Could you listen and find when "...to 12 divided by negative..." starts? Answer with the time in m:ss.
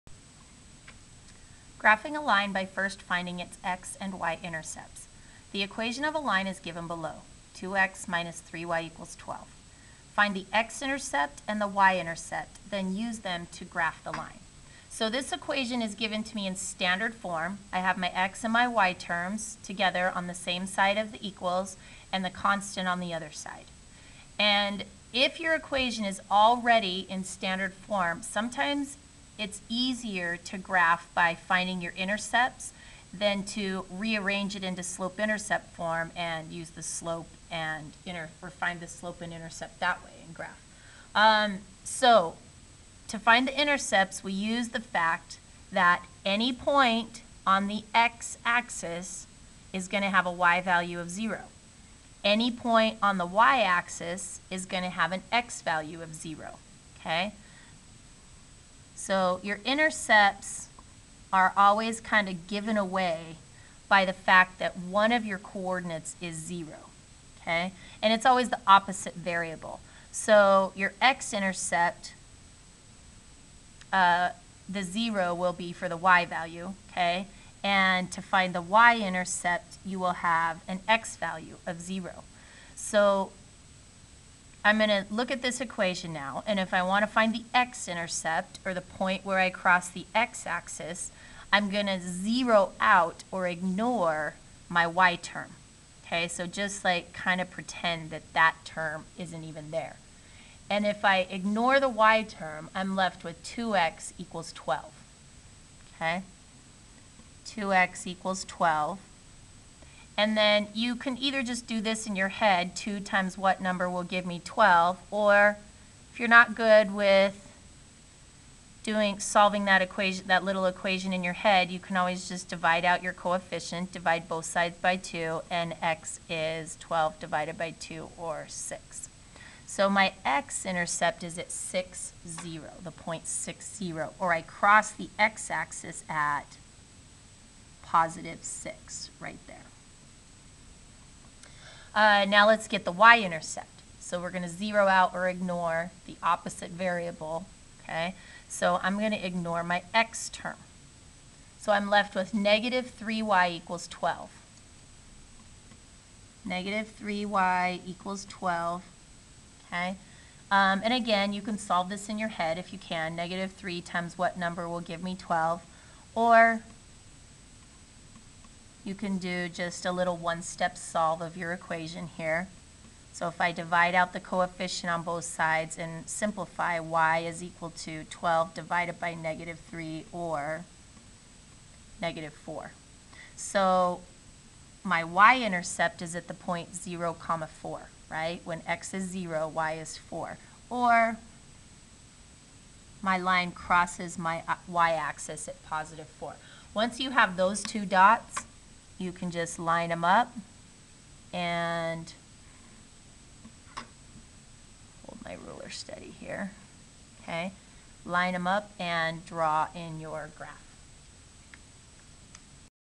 2:57.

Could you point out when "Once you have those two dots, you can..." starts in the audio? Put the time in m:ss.
3:16.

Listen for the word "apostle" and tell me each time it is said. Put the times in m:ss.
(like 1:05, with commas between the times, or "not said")
not said.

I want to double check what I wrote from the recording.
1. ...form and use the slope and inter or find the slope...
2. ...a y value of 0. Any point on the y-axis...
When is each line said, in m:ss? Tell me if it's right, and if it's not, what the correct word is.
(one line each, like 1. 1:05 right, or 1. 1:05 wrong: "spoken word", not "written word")
1. 0:35 right
2. 0:50 right.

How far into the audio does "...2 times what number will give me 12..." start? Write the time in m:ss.
1:52.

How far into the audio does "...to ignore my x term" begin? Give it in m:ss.
2:29.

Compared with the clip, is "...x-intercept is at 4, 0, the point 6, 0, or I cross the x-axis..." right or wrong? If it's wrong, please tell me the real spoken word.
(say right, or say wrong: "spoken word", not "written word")
wrong: "6", not "4".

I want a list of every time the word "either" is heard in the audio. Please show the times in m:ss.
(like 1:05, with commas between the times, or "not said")
1:51.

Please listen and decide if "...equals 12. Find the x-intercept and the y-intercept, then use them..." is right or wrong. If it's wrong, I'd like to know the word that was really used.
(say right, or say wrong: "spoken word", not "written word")
right.